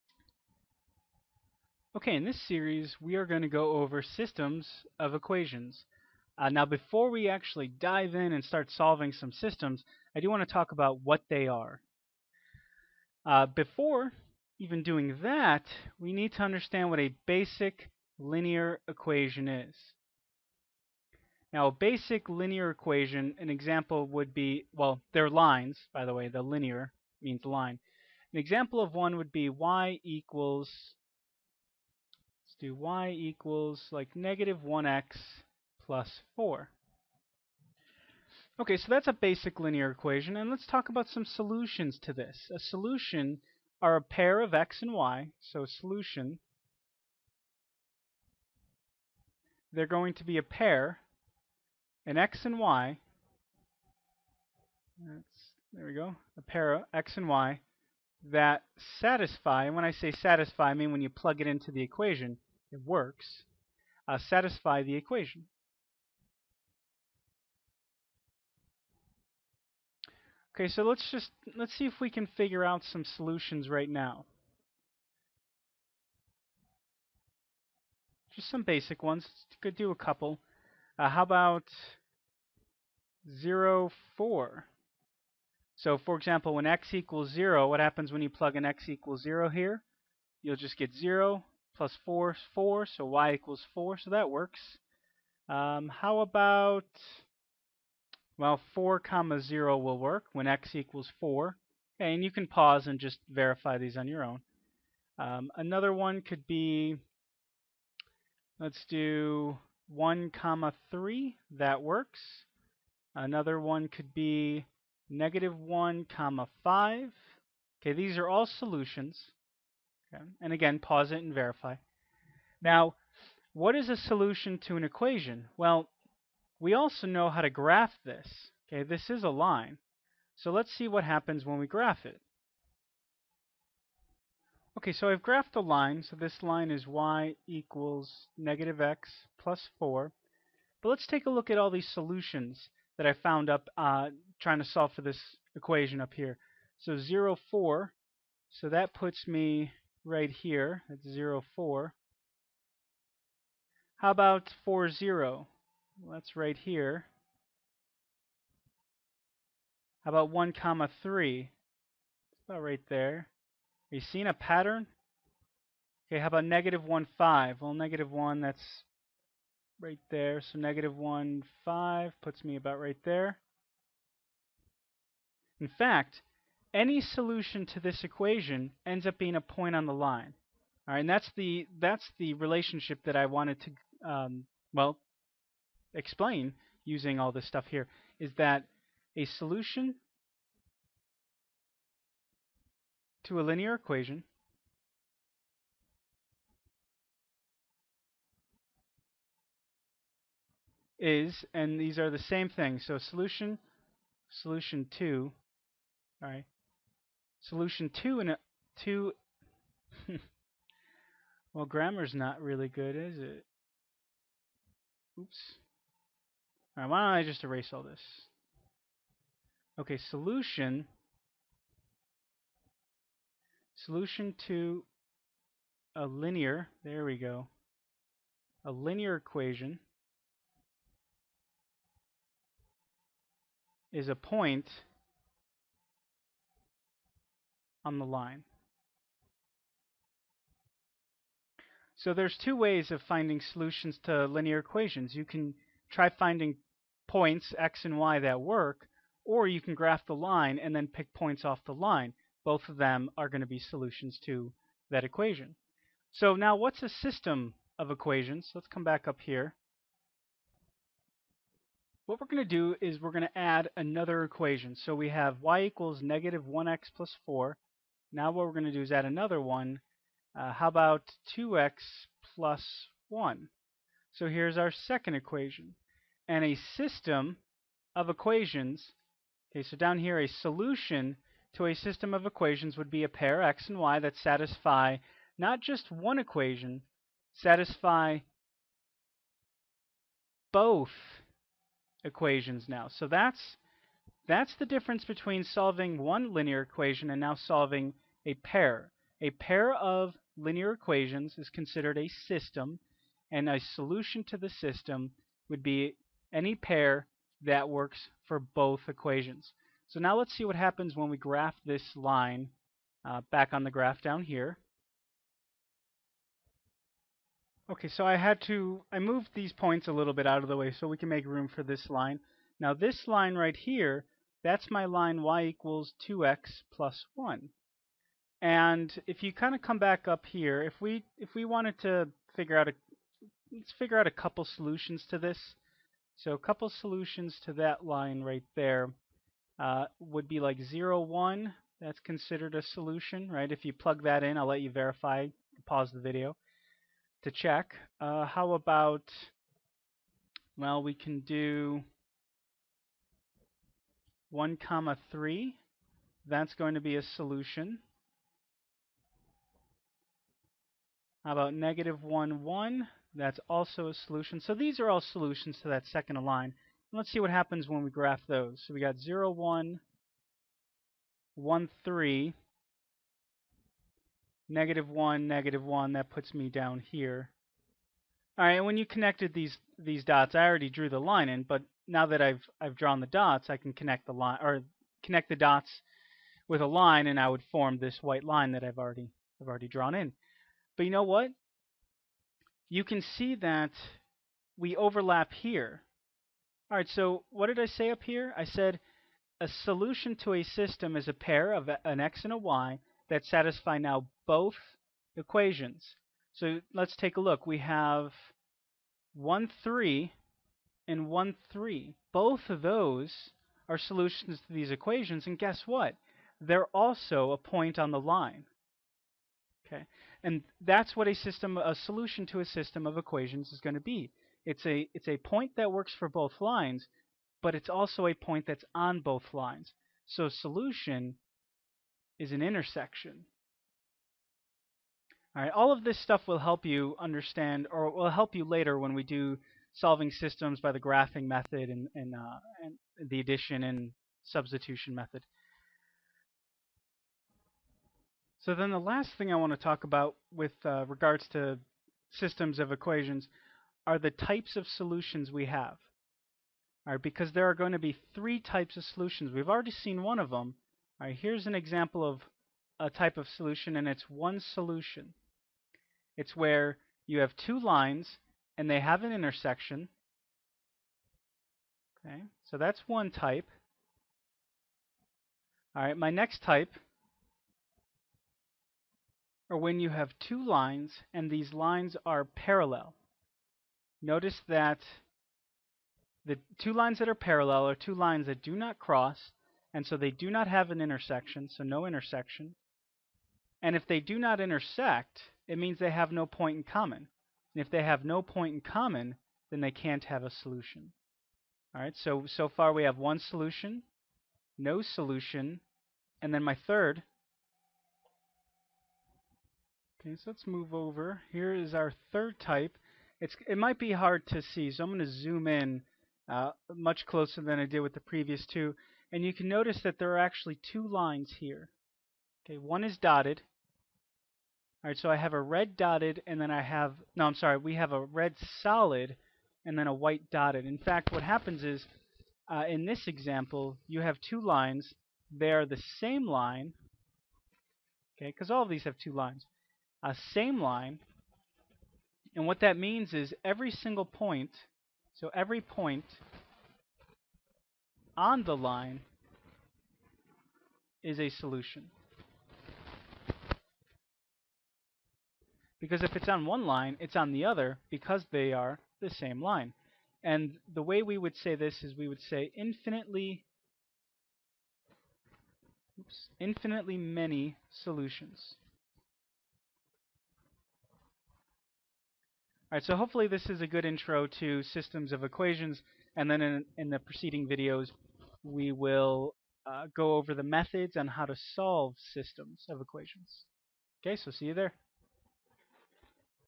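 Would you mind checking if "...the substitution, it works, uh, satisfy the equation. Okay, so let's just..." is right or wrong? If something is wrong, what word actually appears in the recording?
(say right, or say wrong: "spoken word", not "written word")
wrong: "equation", not "substitution".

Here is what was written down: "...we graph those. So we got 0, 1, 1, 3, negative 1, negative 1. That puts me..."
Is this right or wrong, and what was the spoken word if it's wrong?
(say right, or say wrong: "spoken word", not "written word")
right.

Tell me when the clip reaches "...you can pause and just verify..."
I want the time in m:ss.
1:42.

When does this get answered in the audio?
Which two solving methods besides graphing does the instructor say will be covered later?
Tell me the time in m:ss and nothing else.
7:23.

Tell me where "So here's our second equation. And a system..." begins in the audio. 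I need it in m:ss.
4:34.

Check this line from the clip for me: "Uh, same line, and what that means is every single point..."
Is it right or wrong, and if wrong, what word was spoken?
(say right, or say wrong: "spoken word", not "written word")
right.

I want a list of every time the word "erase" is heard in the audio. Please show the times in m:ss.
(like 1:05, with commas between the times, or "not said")
3:37.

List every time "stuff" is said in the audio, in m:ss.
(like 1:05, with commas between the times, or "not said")
3:07, 7:16.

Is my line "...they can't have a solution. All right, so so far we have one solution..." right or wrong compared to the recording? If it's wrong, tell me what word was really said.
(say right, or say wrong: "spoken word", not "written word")
right.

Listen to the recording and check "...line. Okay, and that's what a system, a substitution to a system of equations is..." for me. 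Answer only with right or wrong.
wrong.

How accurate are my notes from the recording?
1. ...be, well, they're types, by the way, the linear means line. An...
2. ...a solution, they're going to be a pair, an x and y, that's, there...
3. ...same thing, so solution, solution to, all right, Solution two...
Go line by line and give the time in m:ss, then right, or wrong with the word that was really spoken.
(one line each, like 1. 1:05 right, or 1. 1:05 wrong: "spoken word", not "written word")
1. 0:24 wrong: "lines", not "types"
2. 0:45 right
3. 3:22 right.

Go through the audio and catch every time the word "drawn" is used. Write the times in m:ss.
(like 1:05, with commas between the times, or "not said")
6:22, 6:29.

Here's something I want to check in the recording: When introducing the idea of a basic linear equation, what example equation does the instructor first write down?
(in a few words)
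y = -1x + 4.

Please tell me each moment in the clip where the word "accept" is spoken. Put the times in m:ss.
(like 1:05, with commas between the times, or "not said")
not said.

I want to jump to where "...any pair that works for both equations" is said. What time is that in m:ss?
5:06.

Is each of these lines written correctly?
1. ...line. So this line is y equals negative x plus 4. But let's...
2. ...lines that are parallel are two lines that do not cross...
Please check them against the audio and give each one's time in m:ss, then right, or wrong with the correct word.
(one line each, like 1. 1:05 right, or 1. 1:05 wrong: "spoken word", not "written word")
1. 2:15 right
2. 8:06 right.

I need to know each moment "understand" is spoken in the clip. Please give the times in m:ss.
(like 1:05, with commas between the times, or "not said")
0:16, 7:16.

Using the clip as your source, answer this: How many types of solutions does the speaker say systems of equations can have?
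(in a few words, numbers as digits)
3.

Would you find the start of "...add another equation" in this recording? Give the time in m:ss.
4:23.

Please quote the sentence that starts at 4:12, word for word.
Both of them are going to be solutions to that equation.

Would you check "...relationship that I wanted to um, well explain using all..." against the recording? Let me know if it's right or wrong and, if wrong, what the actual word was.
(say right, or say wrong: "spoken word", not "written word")
right.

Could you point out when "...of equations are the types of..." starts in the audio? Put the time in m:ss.
7:32.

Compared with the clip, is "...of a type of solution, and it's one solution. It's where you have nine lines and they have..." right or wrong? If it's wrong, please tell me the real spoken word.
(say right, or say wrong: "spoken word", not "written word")
wrong: "two", not "nine".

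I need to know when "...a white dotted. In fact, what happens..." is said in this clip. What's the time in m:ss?
8:49.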